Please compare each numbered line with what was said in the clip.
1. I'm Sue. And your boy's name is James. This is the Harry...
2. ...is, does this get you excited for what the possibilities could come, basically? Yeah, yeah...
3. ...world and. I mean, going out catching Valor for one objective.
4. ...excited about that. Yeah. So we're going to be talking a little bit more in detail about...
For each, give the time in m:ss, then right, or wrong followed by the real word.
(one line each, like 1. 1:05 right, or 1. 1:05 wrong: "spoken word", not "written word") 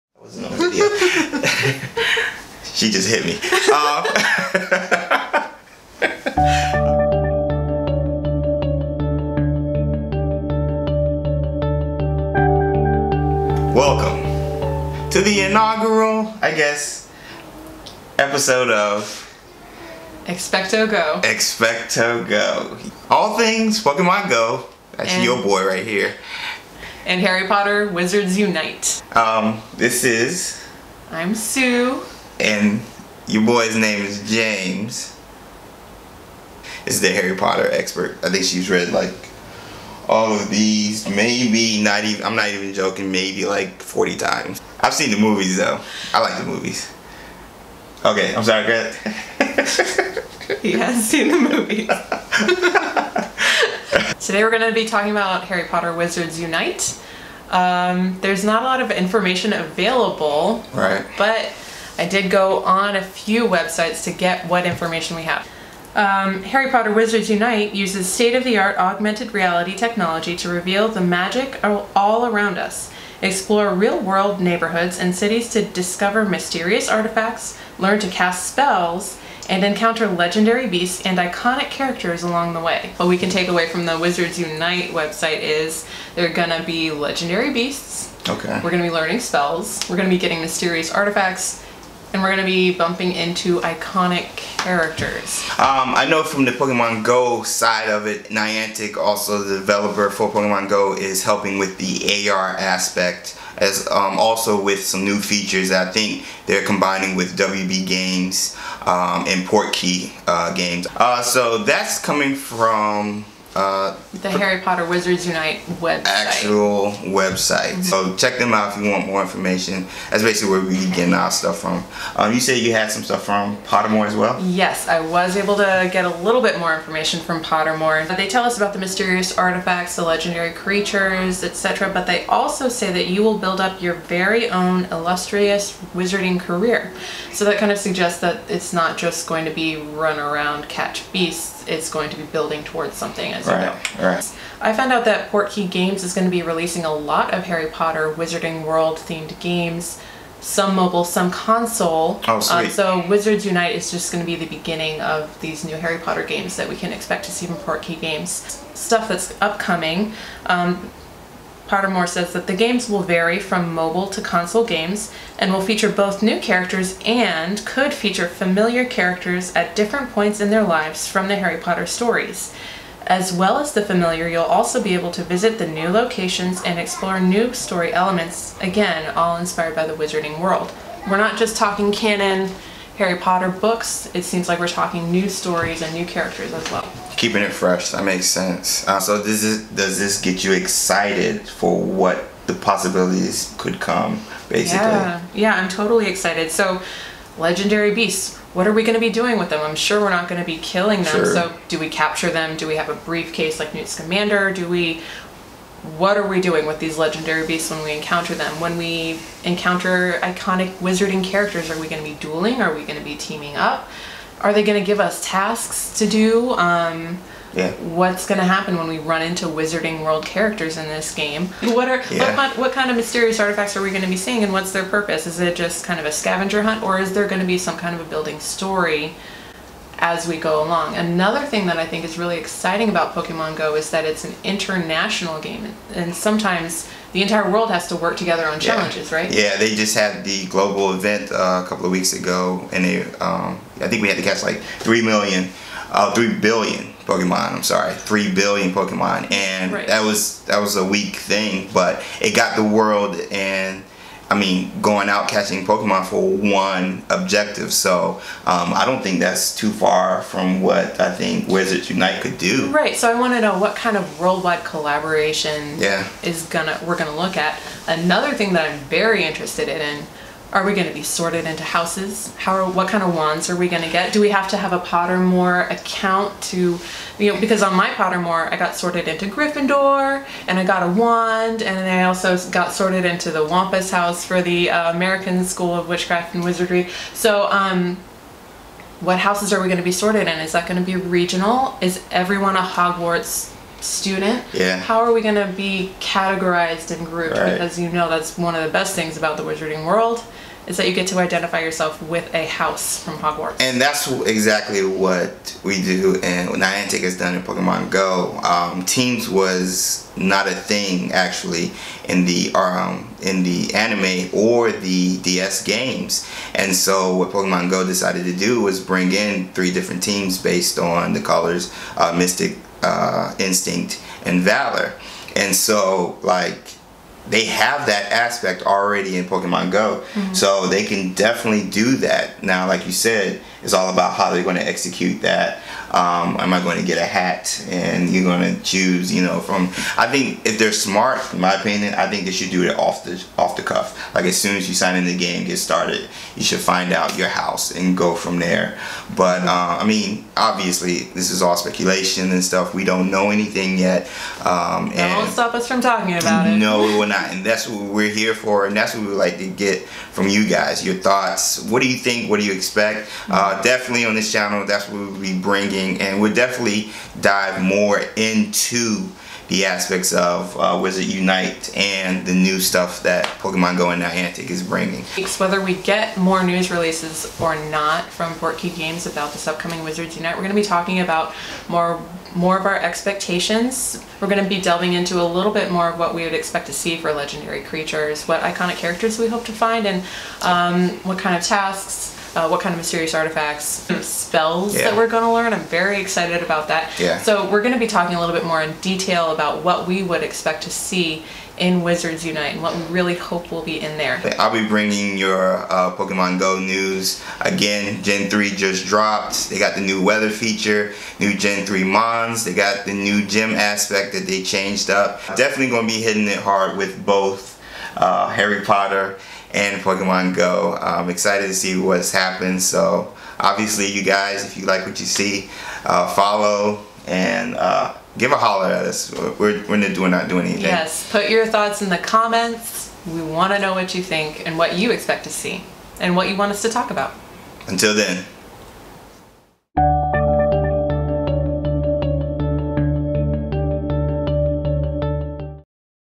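1. 0:31 right
2. 3:09 right
3. 4:12 wrong: "Pokemon", not "Valor"
4. 6:35 right.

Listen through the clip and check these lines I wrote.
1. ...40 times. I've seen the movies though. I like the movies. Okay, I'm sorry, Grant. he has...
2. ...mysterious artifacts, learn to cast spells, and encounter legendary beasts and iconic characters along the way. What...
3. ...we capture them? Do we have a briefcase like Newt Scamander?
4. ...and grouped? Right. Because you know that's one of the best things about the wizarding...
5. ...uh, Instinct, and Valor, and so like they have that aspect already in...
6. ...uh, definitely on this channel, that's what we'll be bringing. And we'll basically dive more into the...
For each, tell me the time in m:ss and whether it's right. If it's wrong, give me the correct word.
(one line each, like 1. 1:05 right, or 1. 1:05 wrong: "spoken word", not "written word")
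1. 0:43 right
2. 1:16 right
3. 3:21 right
4. 4:56 right
5. 5:22 right
6. 6:03 wrong: "definitely", not "basically".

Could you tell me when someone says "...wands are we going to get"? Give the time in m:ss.
4:33.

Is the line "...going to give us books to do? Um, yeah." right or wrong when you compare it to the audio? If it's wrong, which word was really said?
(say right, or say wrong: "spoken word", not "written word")
wrong: "tasks", not "books".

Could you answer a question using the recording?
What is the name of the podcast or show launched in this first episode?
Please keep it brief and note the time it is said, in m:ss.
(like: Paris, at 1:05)
XpectoGO, at 0:20.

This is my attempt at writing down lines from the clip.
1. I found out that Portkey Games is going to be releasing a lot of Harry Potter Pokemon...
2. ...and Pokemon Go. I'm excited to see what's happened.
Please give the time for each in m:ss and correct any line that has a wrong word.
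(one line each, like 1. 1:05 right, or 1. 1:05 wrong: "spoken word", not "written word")
1. 2:24 wrong: "Wizarding", not "Pokemon"
2. 6:59 right.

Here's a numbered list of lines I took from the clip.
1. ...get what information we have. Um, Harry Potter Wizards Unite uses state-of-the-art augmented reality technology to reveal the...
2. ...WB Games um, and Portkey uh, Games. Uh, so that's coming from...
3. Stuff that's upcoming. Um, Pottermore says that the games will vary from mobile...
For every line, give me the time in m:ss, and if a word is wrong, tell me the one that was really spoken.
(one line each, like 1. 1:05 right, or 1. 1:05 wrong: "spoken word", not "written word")
1. 1:04 right
2. 1:47 right
3. 2:38 right.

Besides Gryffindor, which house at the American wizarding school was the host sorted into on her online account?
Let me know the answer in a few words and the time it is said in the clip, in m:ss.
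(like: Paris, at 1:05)
Wampus, at 4:43.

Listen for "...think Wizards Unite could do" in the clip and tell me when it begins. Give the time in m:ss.
4:21.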